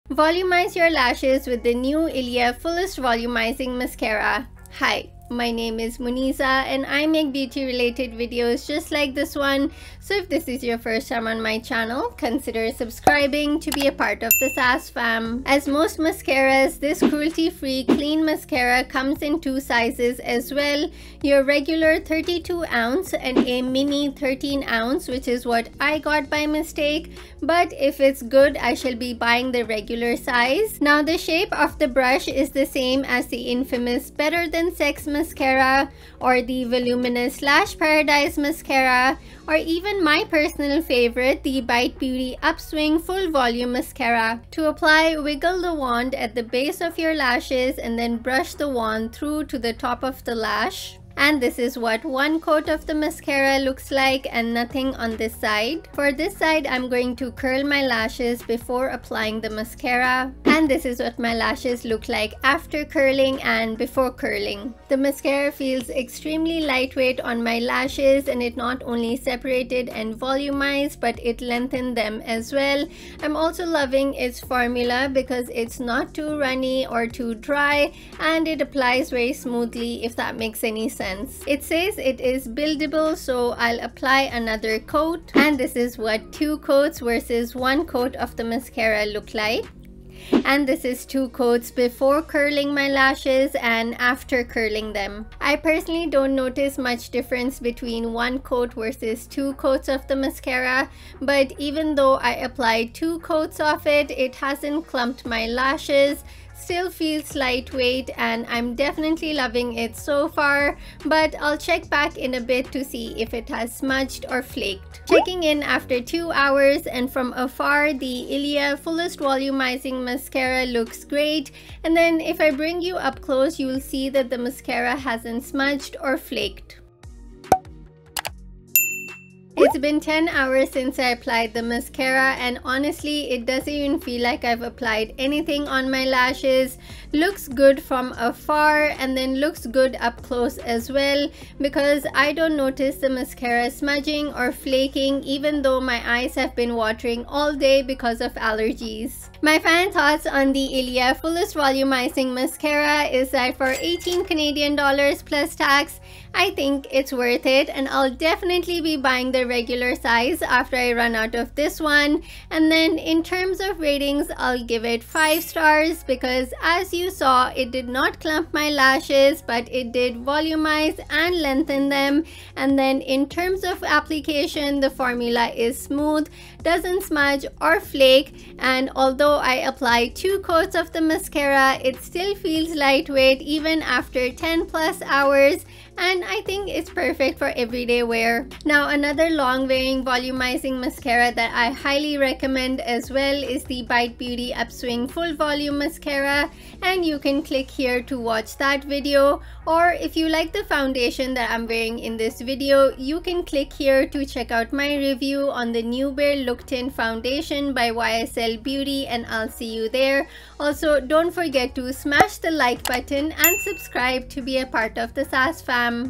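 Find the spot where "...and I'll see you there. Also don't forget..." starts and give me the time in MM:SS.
03:29.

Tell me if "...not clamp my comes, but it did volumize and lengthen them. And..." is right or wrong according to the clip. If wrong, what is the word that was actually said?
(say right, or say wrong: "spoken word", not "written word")
wrong: "lashes", not "comes".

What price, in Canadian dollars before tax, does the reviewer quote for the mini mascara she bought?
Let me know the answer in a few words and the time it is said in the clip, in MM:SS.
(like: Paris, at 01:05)
18, at 02:33.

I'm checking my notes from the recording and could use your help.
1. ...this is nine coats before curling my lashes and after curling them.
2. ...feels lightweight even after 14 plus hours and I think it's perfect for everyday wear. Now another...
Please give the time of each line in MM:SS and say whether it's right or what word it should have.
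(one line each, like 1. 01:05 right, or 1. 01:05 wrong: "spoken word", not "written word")
1. 01:30 wrong: "two", not "nine"
2. 03:02 wrong: "10", not "14".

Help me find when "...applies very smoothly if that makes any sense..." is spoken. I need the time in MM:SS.
01:18.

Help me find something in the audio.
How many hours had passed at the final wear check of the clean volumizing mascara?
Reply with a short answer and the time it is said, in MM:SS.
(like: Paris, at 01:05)
10, at 02:09.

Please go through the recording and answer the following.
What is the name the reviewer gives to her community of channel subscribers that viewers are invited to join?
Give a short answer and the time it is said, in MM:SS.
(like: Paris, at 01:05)
SAS fam, at 00:14.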